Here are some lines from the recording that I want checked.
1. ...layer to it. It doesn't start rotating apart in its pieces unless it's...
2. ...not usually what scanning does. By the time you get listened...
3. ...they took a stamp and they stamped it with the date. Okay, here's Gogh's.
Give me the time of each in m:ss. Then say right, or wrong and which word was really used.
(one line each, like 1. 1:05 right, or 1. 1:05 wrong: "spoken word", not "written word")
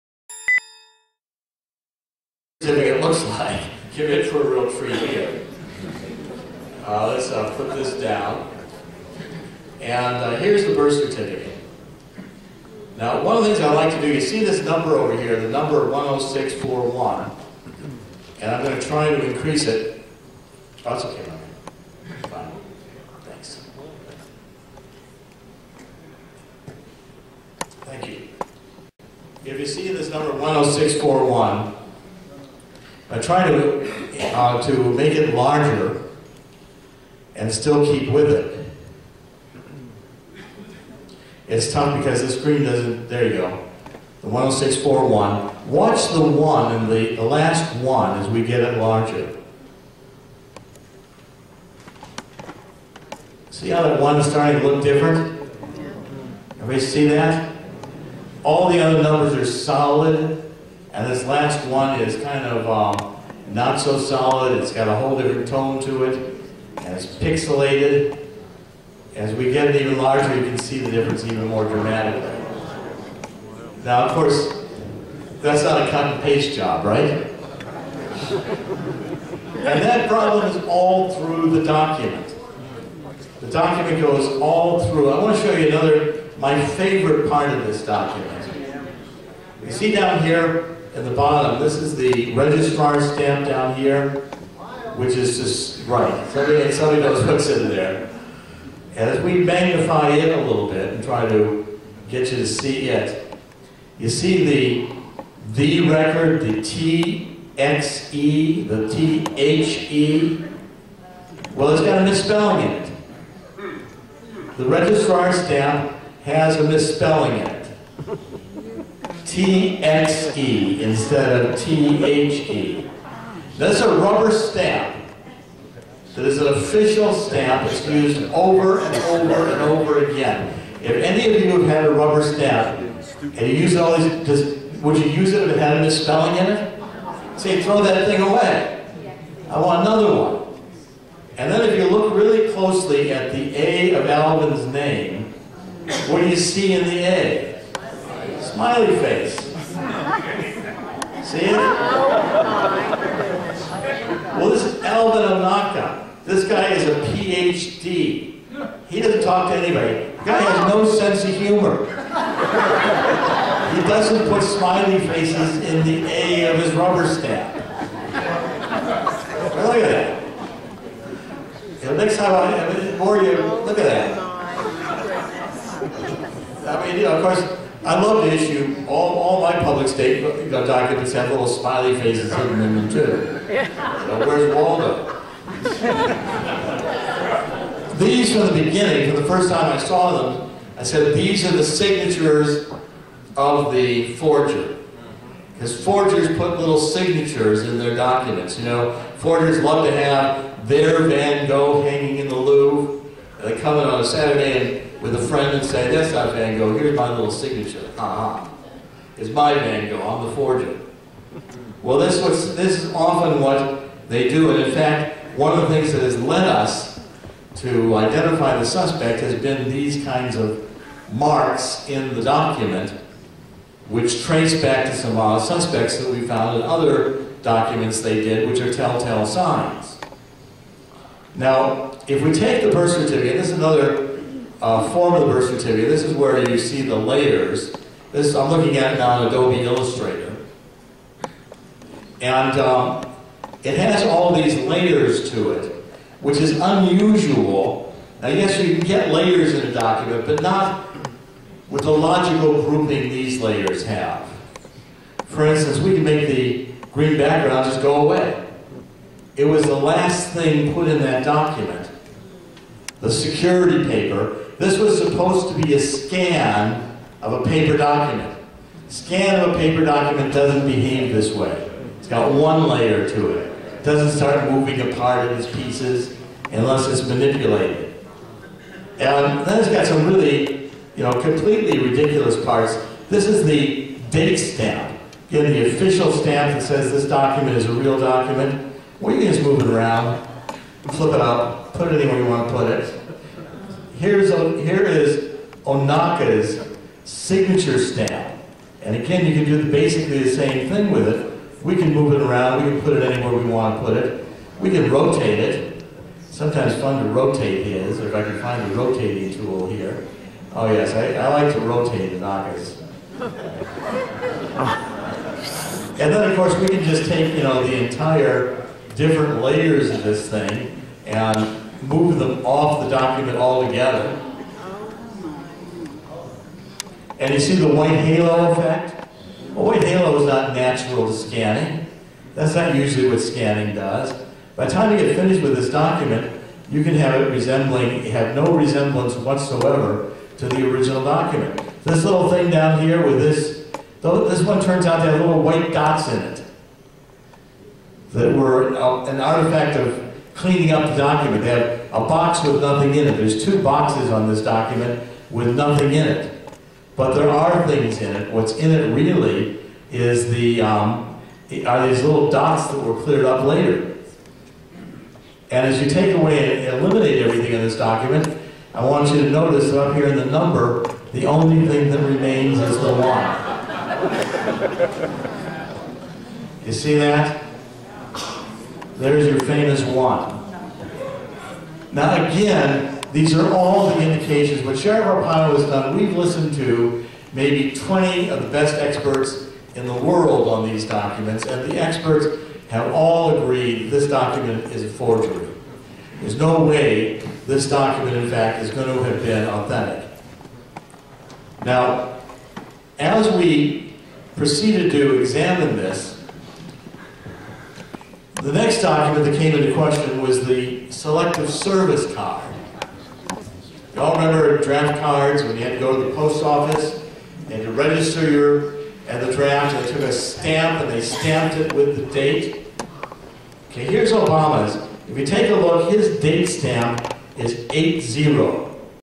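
1. 4:32 wrong: "moving", not "rotating"
2. 5:32 wrong: "finished", not "listened"
3. 6:59 wrong: "Obama", not "Gogh".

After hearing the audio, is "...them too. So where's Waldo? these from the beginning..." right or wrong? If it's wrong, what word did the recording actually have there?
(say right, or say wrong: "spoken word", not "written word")
right.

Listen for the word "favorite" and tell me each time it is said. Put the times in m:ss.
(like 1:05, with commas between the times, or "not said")
1:26.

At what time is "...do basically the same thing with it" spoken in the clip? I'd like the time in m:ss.
4:59.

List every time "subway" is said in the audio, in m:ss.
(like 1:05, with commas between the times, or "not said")
not said.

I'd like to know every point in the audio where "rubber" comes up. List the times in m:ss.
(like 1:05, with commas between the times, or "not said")
2:03, 2:11, 2:46.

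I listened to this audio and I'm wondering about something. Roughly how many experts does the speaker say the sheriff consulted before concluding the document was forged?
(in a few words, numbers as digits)
20.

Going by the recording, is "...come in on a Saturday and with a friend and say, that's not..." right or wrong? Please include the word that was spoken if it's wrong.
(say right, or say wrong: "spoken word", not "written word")
right.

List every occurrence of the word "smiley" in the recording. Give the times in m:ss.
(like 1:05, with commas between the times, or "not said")
2:28, 2:44, 3:01.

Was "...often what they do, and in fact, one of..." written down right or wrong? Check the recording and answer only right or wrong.
right.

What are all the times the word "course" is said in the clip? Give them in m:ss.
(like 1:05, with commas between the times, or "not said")
1:14, 2:57, 5:16.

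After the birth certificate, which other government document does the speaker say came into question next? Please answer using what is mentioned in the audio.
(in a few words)
Selective Service Card.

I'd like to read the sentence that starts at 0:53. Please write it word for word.
See how that one is starting to look different?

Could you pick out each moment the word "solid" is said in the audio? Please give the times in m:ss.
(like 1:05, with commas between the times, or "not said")
0:59, 1:03.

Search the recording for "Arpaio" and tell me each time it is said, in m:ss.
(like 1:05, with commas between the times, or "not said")
6:25.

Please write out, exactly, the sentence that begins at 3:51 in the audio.
Now, if we take the birth certificate, this is another uh, form the birth certificate.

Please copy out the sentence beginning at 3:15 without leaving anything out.
Because forgers put little signatures in their documents, you know.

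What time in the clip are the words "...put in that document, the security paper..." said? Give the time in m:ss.
4:20.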